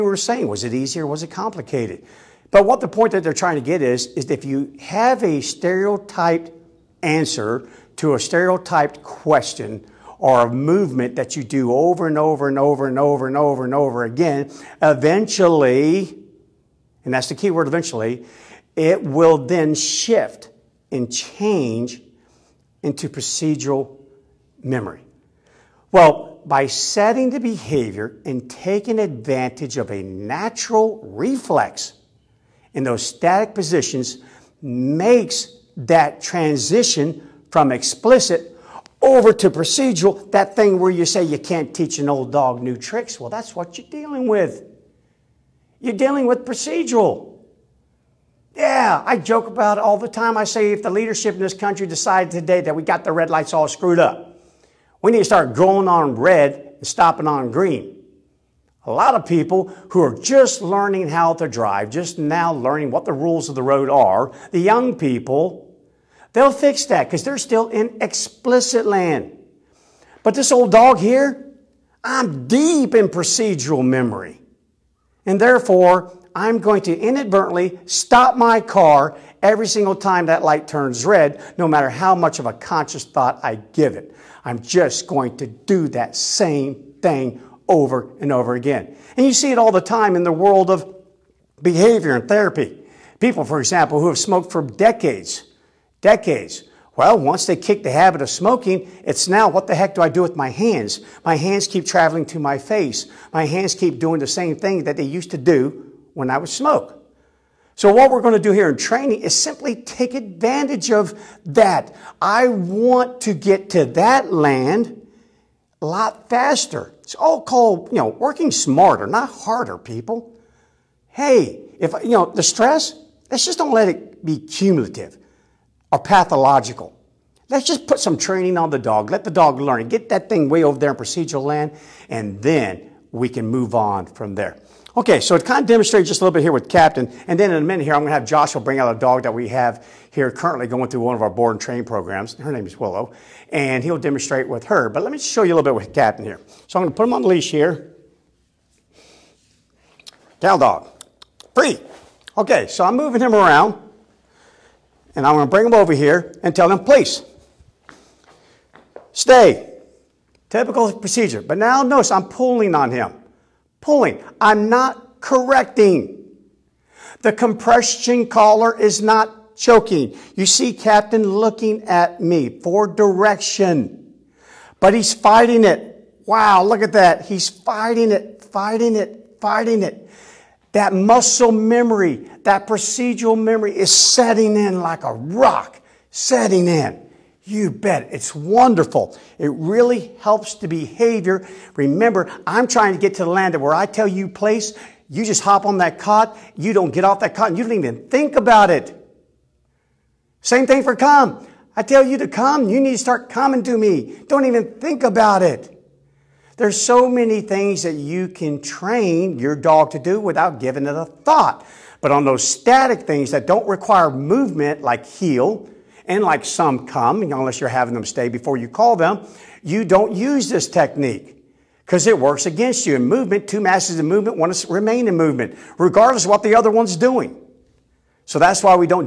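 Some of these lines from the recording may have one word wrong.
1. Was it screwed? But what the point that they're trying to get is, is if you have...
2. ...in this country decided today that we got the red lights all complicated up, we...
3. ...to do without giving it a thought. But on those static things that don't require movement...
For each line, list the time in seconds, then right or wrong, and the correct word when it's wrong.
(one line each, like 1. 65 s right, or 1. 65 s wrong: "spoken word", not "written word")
1. 1 s wrong: "complicated", not "screwed"
2. 51 s wrong: "screwed", not "complicated"
3. 209 s right.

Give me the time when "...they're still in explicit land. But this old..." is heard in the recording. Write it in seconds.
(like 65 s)
67 s.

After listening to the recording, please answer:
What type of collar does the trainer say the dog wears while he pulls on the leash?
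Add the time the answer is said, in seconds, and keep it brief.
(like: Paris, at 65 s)
Compression collar, at 167 s.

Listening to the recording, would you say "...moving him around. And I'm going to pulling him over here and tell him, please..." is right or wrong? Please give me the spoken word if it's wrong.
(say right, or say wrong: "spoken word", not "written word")
wrong: "bring", not "pulling".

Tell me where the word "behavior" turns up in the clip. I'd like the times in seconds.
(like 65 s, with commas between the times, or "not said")
27 s, 91 s, 190 s.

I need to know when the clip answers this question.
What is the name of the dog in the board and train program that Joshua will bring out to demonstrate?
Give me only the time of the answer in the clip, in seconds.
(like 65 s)
142 s.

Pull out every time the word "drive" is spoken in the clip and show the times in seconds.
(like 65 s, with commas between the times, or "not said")
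61 s.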